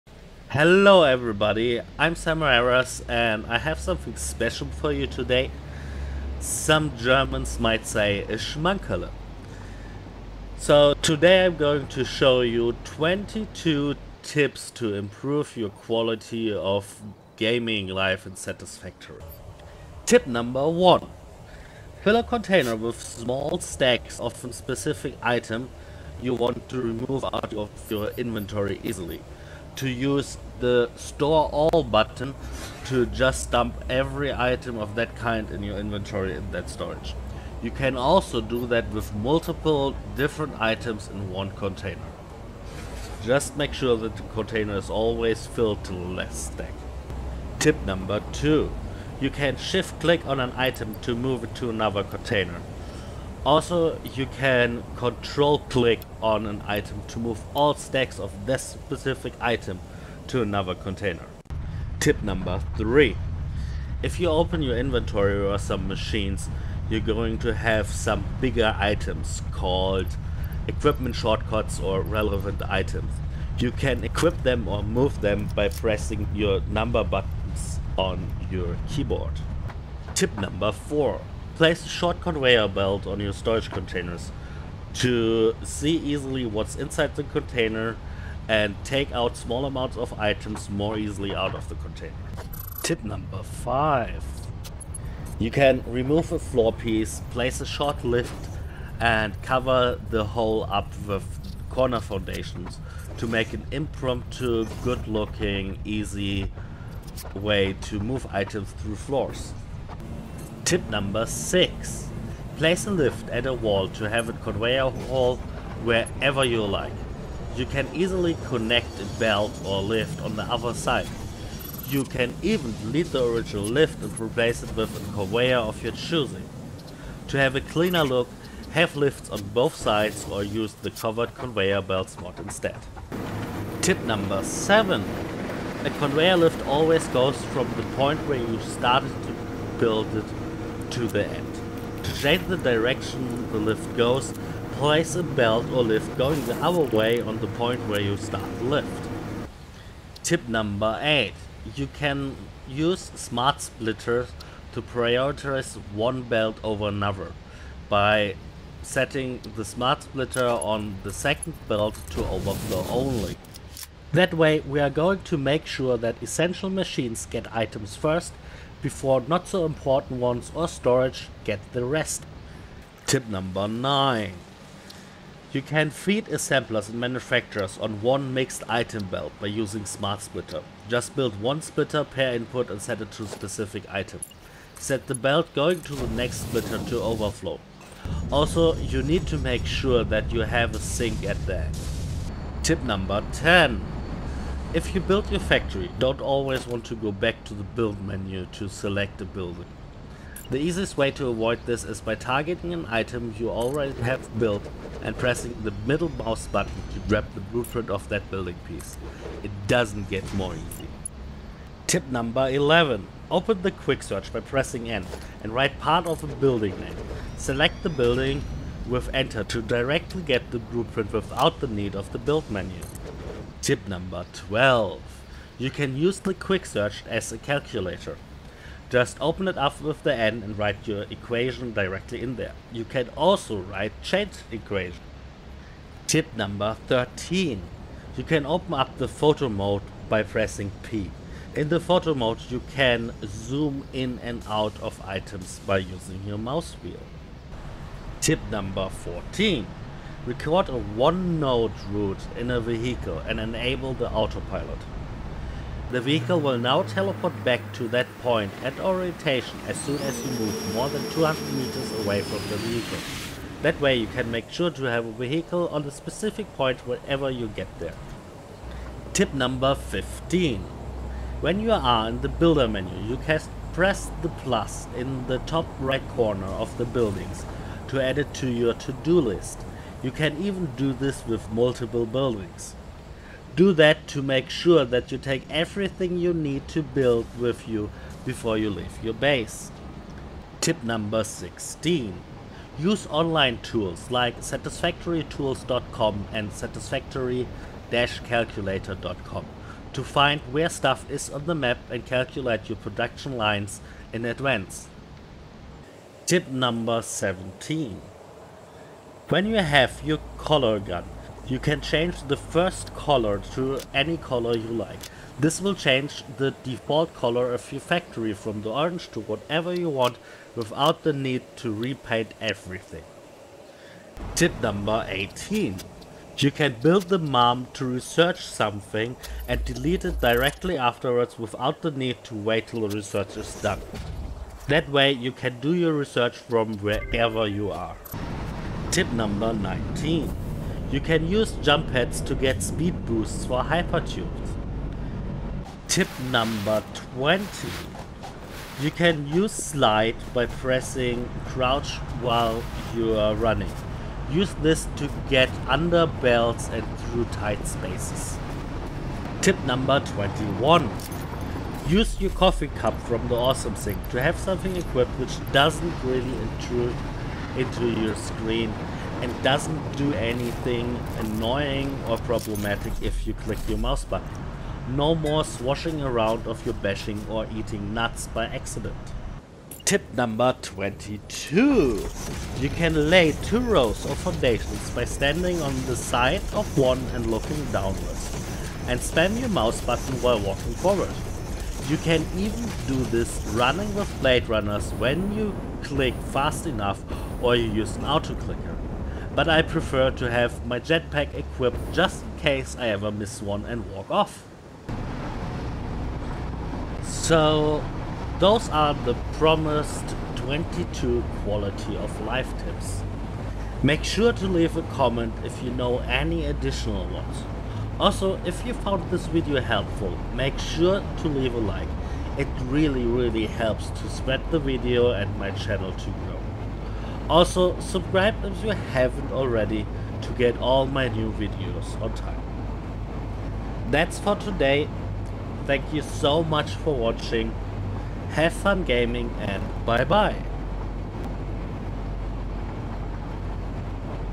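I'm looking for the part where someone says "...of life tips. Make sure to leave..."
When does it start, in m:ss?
6:51.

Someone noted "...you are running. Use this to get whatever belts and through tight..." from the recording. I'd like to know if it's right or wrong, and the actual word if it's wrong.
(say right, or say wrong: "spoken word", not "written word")
wrong: "under", not "whatever".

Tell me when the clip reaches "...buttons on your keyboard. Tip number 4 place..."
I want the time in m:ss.
1:17.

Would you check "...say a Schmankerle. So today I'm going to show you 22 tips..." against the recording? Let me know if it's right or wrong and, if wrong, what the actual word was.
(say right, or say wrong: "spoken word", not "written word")
right.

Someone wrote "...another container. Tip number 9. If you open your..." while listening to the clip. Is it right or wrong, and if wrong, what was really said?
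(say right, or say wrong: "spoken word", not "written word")
wrong: "3", not "9".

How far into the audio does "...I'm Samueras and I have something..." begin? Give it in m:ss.
0:01.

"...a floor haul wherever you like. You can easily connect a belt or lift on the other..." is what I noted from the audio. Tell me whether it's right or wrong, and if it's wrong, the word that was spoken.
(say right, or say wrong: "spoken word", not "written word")
wrong: "conveyor", not "floor".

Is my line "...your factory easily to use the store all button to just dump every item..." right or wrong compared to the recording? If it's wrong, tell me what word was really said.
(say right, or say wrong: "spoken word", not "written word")
wrong: "inventory", not "factory".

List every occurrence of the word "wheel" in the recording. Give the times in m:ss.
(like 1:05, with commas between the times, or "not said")
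4:06.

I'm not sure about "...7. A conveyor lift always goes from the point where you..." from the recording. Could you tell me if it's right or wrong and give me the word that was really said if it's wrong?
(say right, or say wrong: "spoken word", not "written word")
right.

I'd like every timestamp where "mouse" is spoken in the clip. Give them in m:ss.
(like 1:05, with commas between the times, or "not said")
3:26, 4:06, 6:13, 6:29.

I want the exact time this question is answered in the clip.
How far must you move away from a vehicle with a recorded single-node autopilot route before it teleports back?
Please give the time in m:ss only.
4:21.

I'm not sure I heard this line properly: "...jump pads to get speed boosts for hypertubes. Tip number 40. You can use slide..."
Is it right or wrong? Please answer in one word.
wrong.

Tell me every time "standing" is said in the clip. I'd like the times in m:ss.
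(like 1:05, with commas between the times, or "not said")
6:25.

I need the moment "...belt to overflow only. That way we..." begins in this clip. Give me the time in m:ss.
2:41.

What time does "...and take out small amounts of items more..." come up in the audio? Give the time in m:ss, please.
1:28.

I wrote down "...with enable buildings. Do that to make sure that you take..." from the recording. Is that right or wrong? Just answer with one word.
wrong.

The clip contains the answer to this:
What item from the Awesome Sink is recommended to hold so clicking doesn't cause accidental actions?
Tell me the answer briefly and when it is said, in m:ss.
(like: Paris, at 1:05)
Coffee cup, at 6:02.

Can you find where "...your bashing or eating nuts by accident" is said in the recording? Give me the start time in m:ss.
6:16.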